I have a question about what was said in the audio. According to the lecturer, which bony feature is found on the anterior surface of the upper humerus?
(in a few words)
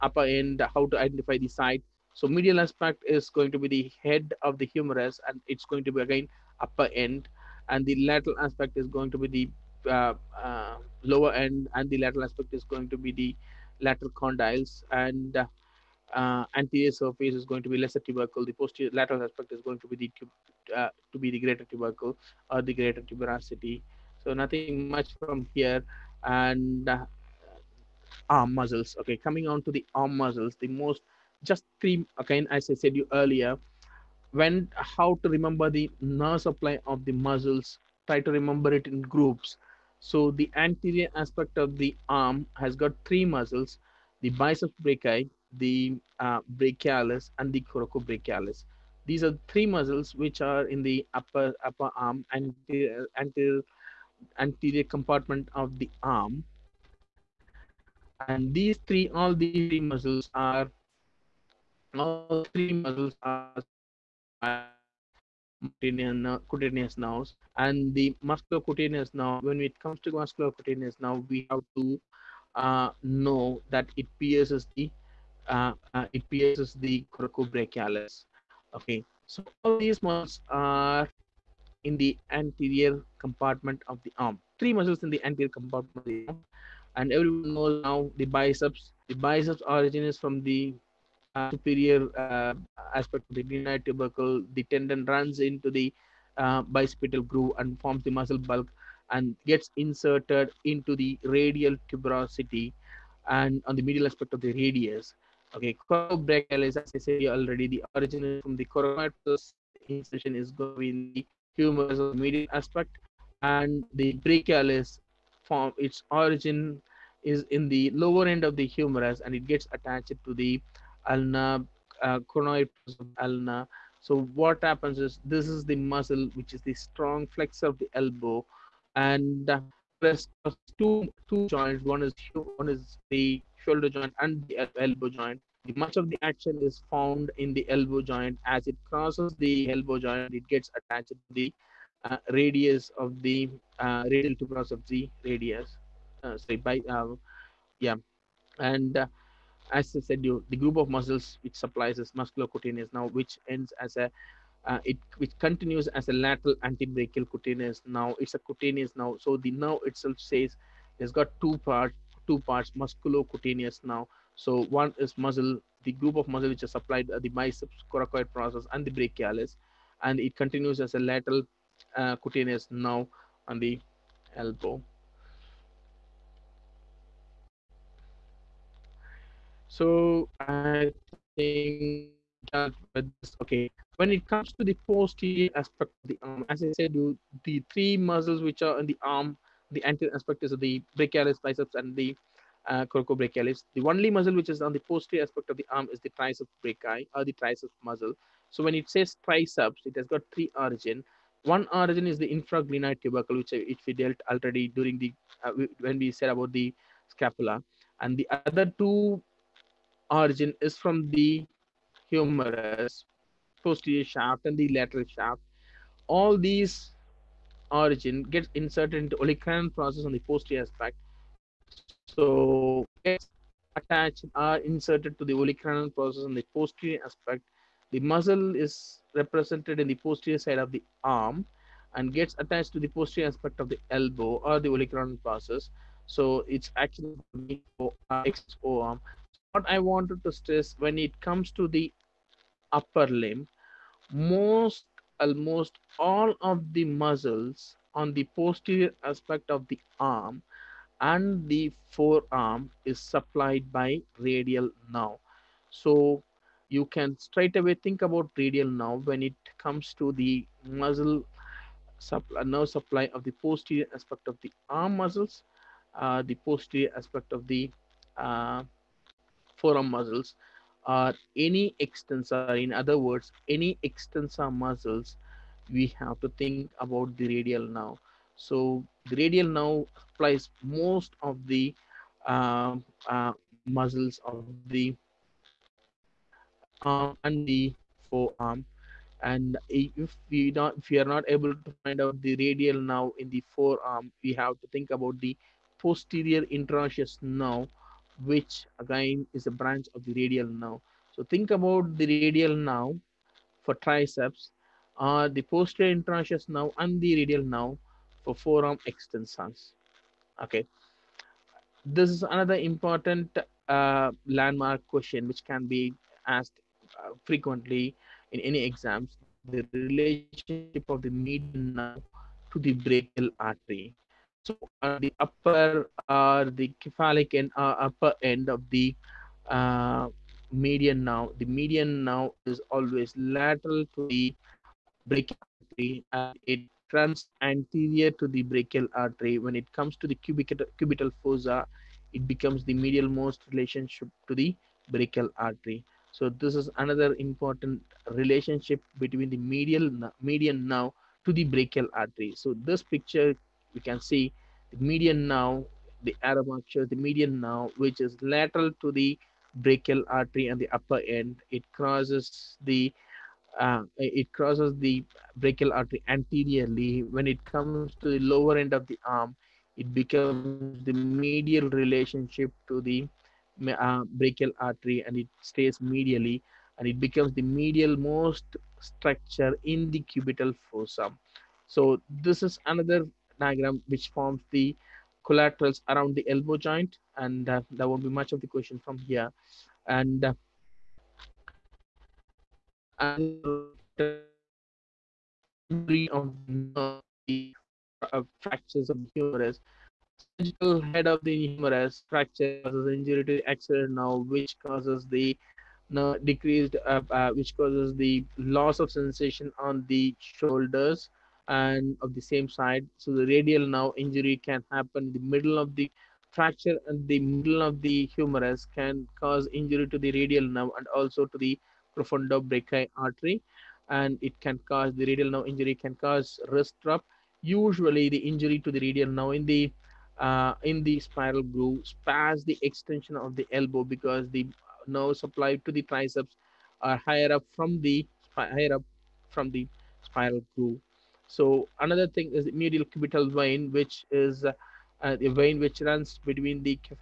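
Lesser tubercle.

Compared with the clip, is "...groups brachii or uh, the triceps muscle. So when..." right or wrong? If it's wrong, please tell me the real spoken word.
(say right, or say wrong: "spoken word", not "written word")
wrong: "triceps", not "groups".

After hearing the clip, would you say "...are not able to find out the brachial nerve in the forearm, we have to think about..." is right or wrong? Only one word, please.
wrong.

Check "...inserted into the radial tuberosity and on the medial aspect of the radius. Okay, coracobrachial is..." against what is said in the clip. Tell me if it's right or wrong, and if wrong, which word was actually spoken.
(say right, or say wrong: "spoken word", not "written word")
right.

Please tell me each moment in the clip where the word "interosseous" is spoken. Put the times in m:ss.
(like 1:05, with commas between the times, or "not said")
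4:56, 5:05.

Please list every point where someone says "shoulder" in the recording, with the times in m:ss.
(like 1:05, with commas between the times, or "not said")
2:13, 6:50.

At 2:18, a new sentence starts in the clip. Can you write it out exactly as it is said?
As it crosses the elbow joint, it gets attached to the uh, radius of the uh, radial tuberosity of the radius.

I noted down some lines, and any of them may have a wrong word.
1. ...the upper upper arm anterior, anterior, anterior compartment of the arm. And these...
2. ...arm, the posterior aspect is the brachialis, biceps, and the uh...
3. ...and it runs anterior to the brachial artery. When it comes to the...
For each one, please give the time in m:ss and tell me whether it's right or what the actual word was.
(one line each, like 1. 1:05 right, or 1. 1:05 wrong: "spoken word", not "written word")
1. 0:50 right
2. 3:09 wrong: "anterior", not "posterior"
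3. 5:36 right.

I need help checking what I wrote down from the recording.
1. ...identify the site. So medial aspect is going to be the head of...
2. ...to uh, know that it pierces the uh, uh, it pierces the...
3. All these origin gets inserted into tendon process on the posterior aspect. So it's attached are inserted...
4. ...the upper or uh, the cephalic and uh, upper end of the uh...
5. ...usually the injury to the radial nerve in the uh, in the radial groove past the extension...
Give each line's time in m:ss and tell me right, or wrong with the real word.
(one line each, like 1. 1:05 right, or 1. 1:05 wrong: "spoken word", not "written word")
1. 0:00 right
2. 1:11 right
3. 3:36 wrong: "olecranon", not "tendon"
4. 5:24 right
5. 7:07 wrong: "spiral", not "radial".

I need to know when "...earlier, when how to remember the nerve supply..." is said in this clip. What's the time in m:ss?
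0:33.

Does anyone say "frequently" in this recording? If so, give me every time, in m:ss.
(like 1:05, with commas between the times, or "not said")
5:17.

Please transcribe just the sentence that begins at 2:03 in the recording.
So what happens is this is the muscle, which is the strong flexor of the elbow, and there's two two joints.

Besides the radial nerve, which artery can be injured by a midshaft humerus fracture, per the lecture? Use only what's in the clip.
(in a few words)
Profunda brachii artery.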